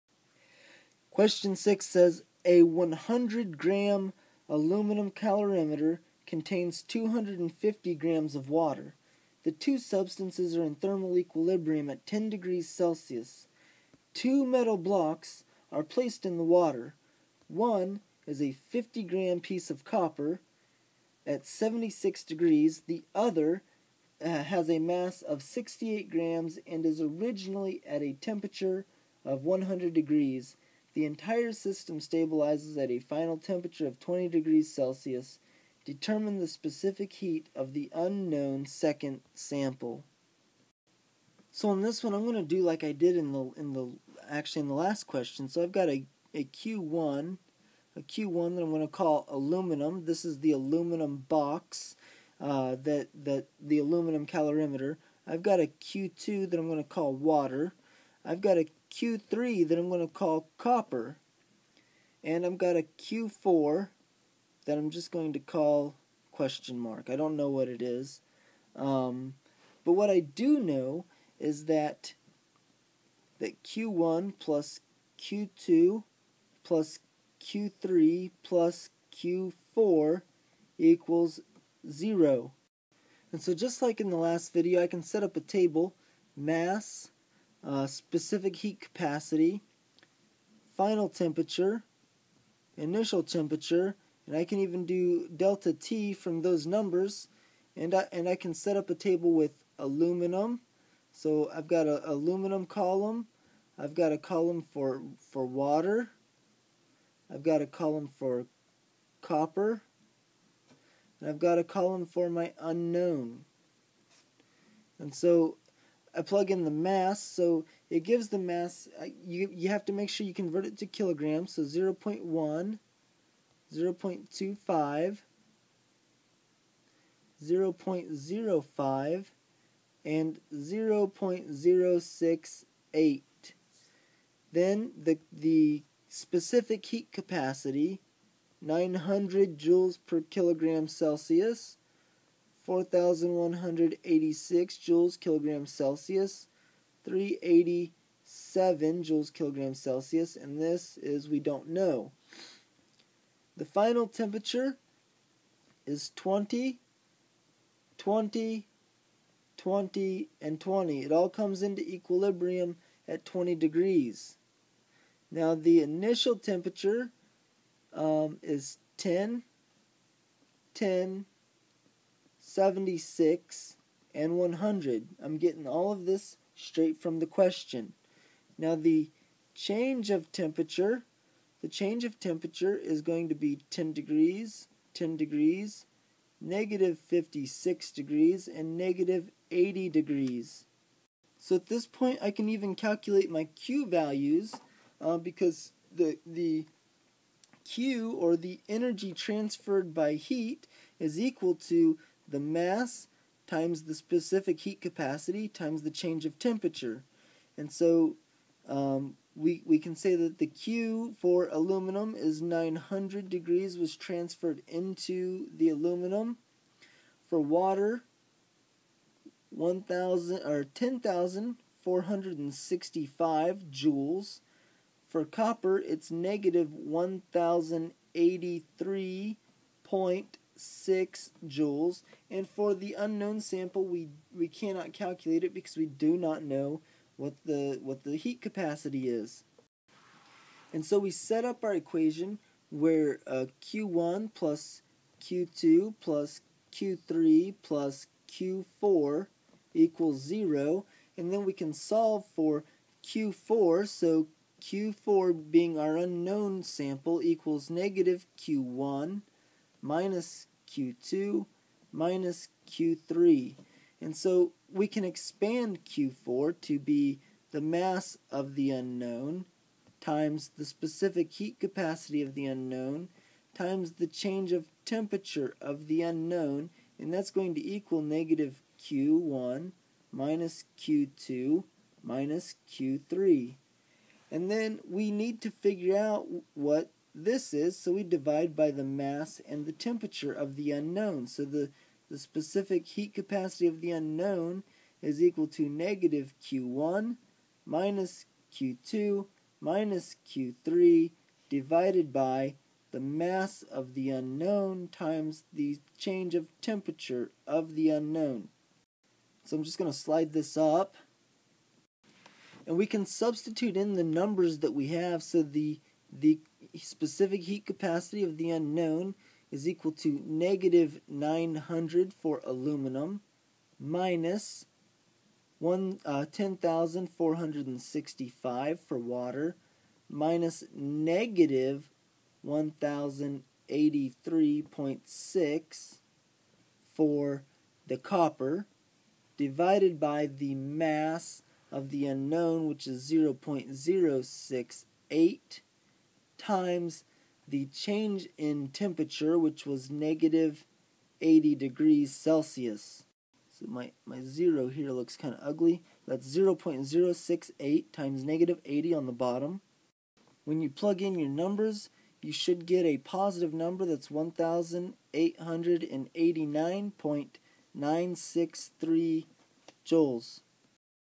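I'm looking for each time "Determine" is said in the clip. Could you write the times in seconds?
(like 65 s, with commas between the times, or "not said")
35 s.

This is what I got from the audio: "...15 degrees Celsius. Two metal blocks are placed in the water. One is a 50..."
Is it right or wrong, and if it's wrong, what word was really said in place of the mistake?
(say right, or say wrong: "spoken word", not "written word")
wrong: "10", not "15".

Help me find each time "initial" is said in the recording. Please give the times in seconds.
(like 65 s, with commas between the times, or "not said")
92 s, 165 s.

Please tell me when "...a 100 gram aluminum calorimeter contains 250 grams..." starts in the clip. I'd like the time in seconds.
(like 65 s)
2 s.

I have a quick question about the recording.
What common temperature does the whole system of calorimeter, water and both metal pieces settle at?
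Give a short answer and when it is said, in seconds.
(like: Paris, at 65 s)
20 degrees Celsius, at 33 s.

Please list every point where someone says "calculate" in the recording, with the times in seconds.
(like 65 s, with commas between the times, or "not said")
192 s, 234 s.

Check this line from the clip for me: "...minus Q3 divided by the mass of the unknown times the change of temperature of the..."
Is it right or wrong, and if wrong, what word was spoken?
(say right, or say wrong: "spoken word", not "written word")
right.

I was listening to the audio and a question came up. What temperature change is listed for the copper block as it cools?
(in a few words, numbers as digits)
-56 degrees.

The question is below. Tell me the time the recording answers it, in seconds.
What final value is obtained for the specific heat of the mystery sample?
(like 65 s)
364 s.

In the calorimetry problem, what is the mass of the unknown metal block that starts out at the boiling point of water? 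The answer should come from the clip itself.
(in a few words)
68 grams.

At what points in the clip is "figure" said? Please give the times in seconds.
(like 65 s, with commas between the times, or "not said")
285 s.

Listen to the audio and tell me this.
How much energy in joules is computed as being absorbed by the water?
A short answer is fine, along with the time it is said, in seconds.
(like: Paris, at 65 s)
10,465 joules, at 220 s.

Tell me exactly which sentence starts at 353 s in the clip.
So my, my zero here looks kind of ugly.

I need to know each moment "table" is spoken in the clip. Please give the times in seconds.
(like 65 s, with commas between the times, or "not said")
85 s, 98 s.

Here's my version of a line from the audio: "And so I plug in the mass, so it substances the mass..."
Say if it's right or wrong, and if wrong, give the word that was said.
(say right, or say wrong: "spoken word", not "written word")
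wrong: "gives", not "substances".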